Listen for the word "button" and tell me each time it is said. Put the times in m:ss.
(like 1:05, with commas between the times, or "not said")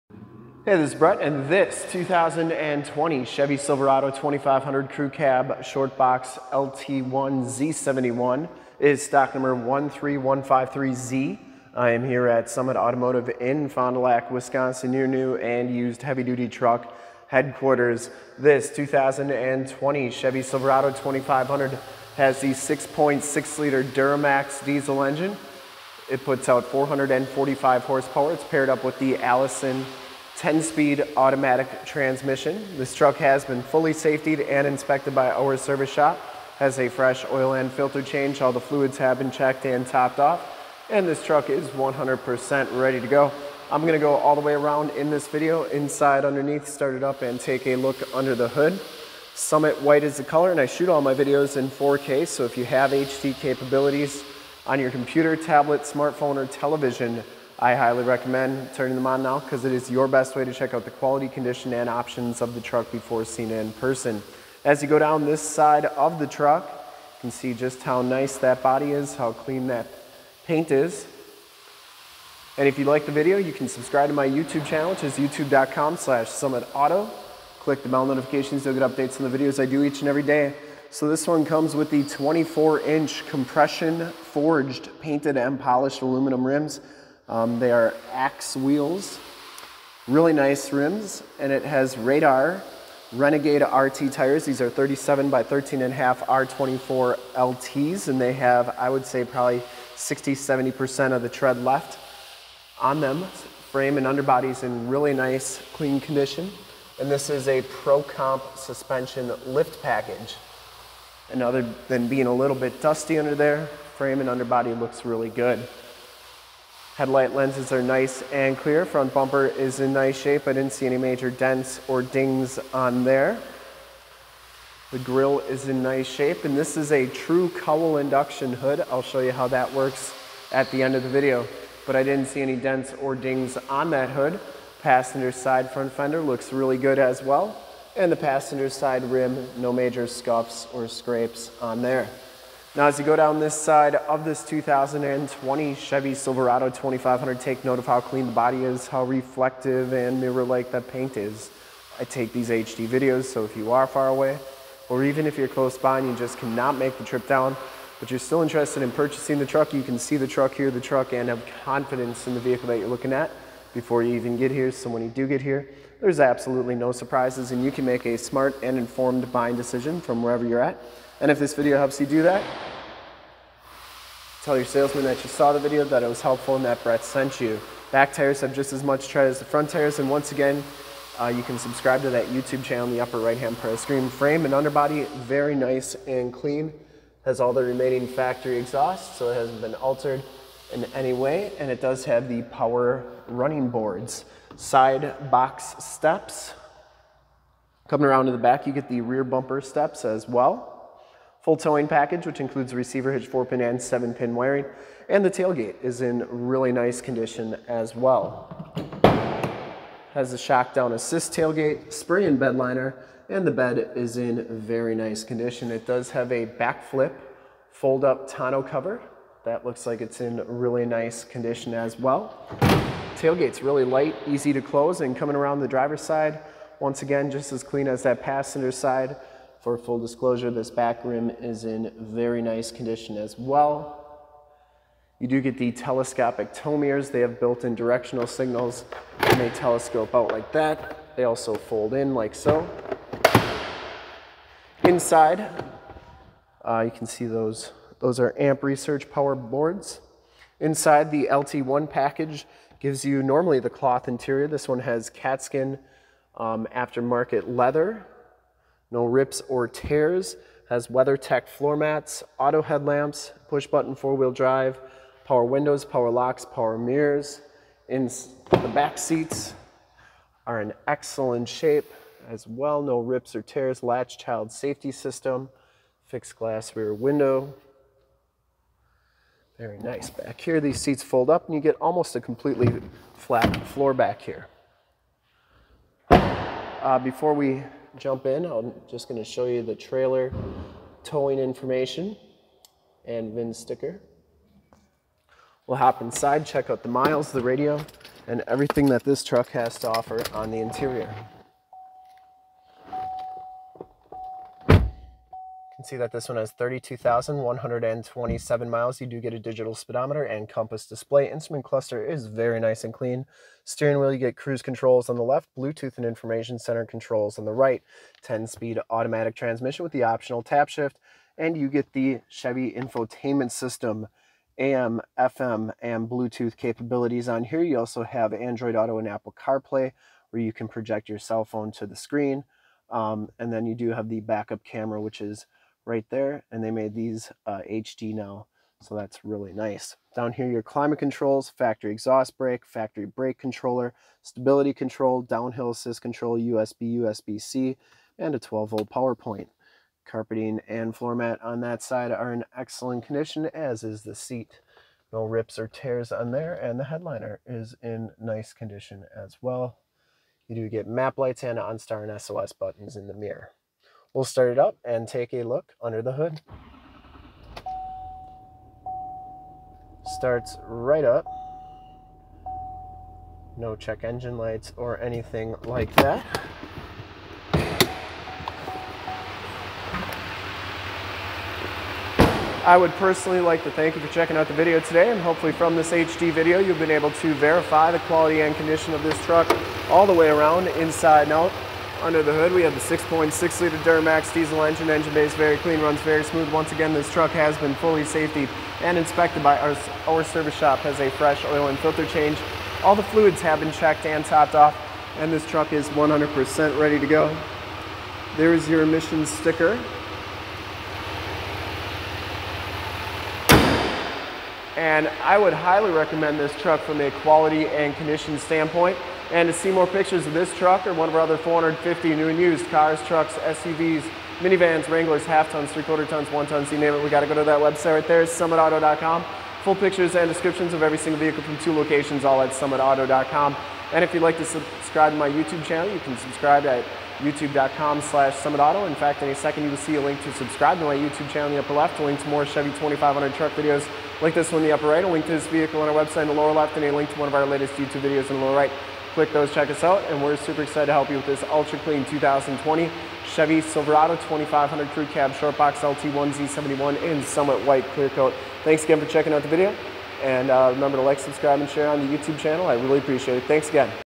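4:23, 6:02.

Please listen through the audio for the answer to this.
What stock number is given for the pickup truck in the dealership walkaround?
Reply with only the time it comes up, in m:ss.
0:09.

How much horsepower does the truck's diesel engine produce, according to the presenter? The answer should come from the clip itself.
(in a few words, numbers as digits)
445.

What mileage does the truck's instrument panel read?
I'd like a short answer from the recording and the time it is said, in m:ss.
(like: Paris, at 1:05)
32,127, at 5:06.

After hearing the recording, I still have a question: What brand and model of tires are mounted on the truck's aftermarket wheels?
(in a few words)
Radar Renegade RT.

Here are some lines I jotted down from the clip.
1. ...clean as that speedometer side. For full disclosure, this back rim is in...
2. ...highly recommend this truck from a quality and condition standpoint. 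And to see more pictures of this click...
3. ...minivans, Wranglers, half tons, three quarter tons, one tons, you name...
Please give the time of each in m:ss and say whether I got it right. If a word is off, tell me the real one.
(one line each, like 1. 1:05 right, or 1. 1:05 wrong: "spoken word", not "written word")
1. 3:47 wrong: "passenger", not "speedometer"
2. 6:55 wrong: "truck", not "click"
3. 7:04 right.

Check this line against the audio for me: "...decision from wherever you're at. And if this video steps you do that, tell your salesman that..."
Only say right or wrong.
wrong.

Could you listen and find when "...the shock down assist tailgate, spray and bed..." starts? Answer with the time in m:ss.
3:30.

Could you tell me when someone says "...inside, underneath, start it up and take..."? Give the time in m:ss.
0:45.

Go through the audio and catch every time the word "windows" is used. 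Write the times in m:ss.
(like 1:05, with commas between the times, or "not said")
4:25, 4:36.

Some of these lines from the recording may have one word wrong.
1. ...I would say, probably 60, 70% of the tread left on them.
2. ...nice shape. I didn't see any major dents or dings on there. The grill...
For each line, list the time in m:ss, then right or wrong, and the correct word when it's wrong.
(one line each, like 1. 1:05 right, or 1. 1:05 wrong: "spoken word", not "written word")
1. 1:38 right
2. 1:59 right.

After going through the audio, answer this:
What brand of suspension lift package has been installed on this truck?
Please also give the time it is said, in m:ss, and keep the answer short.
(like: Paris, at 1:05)
Pro Comp, at 1:47.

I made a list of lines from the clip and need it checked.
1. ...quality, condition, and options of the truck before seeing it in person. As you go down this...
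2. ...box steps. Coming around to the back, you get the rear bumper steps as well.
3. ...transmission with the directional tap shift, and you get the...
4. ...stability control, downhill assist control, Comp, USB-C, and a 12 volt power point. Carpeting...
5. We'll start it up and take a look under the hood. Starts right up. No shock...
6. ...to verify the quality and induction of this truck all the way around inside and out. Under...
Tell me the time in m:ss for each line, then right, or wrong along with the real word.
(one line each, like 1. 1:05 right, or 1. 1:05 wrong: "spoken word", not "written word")
1. 1:00 right
2. 3:15 right
3. 5:19 wrong: "optional", not "directional"
4. 5:44 wrong: "USB", not "Comp"
5. 6:04 wrong: "check", not "shock"
6. 6:27 wrong: "condition", not "induction".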